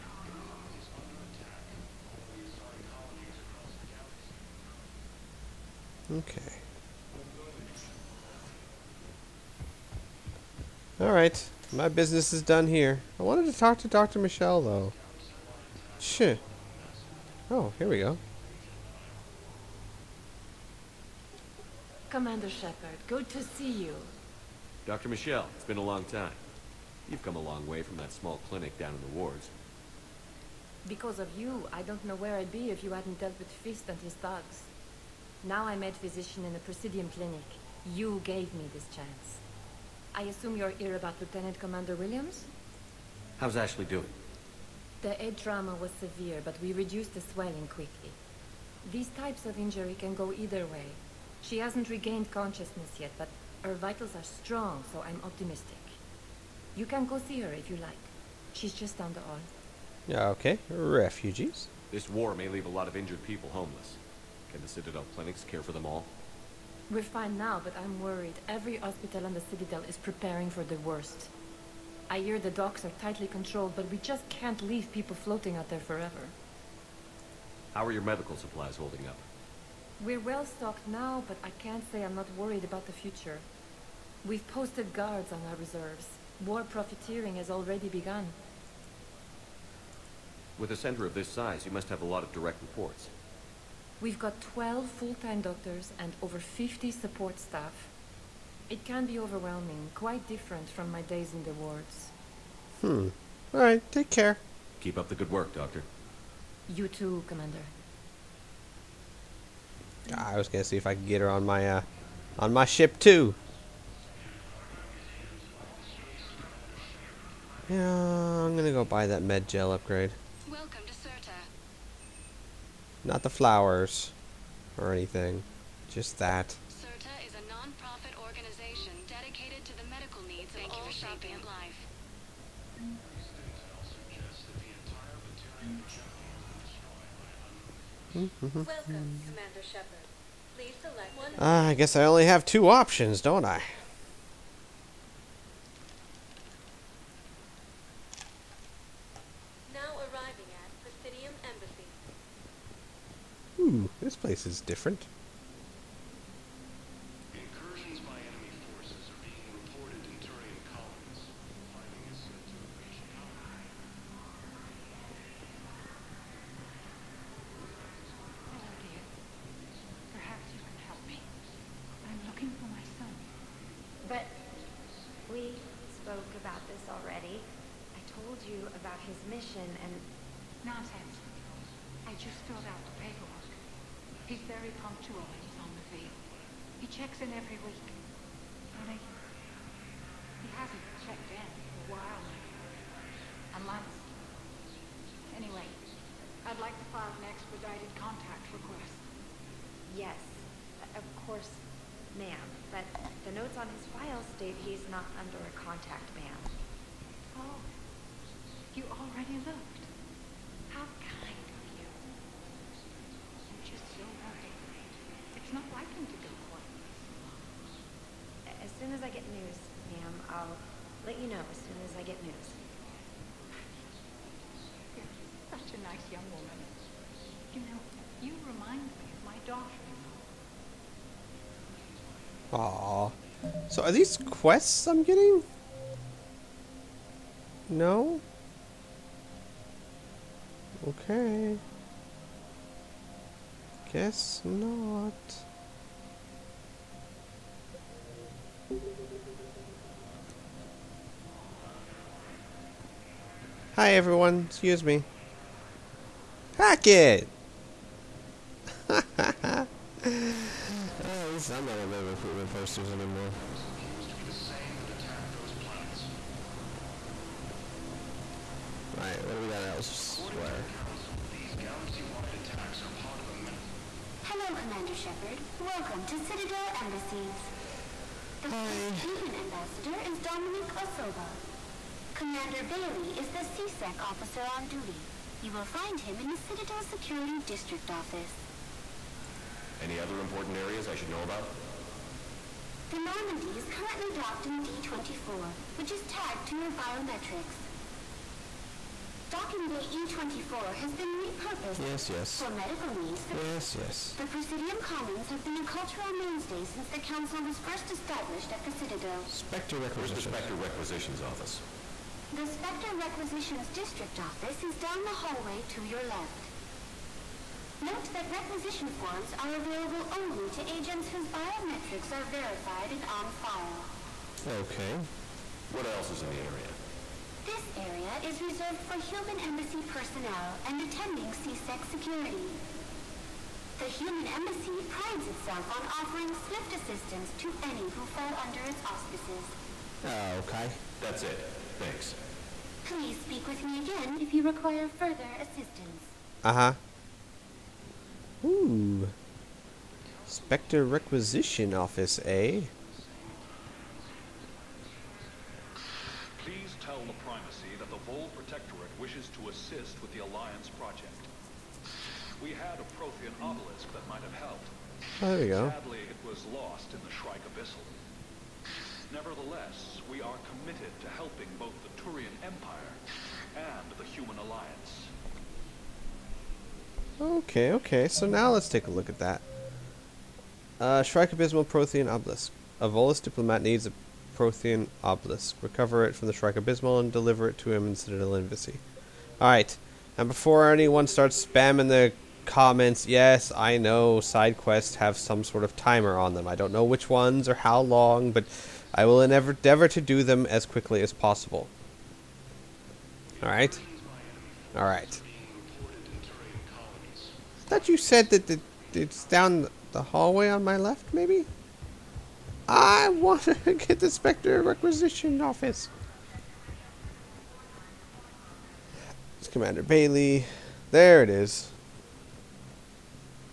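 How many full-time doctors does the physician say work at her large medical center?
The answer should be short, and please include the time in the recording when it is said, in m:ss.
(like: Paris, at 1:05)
12, at 1:34.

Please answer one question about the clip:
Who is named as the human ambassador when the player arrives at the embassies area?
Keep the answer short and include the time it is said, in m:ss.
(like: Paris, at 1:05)
Dominic Osoba, at 4:40.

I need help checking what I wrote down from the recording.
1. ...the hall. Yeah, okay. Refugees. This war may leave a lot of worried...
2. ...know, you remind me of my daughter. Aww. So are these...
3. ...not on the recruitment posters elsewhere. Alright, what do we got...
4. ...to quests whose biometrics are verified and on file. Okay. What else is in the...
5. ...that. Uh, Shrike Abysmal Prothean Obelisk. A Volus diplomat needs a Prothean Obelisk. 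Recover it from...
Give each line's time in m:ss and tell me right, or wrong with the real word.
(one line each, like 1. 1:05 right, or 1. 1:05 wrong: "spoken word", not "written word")
1. 0:59 wrong: "injured", not "worried"
2. 3:47 right
3. 4:21 wrong: "anymore", not "elsewhere"
4. 5:20 wrong: "agents", not "quests"
5. 6:19 right.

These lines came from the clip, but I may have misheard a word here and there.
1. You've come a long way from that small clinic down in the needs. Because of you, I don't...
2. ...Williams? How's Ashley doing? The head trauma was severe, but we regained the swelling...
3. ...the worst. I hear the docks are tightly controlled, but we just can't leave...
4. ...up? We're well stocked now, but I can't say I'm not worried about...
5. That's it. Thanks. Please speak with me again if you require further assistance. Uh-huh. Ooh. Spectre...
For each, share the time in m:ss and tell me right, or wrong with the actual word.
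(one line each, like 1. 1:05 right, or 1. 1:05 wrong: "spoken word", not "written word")
1. 0:27 wrong: "wards", not "needs"
2. 0:41 wrong: "reduced", not "regained"
3. 1:10 right
4. 1:19 right
5. 5:40 right.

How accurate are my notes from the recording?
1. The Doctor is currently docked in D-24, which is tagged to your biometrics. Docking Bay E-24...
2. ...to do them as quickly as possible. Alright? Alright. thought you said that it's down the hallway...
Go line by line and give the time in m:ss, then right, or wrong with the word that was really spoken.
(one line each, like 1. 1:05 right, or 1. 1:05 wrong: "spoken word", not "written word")
1. 4:52 wrong: "Normandy", not "Doctor"
2. 6:39 right.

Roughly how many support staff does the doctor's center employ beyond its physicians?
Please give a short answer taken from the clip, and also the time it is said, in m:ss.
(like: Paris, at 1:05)
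over 50, at 1:36.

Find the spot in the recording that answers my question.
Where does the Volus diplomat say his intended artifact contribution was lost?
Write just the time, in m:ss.
6:07.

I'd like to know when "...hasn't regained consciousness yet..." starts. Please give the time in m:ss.
0:51.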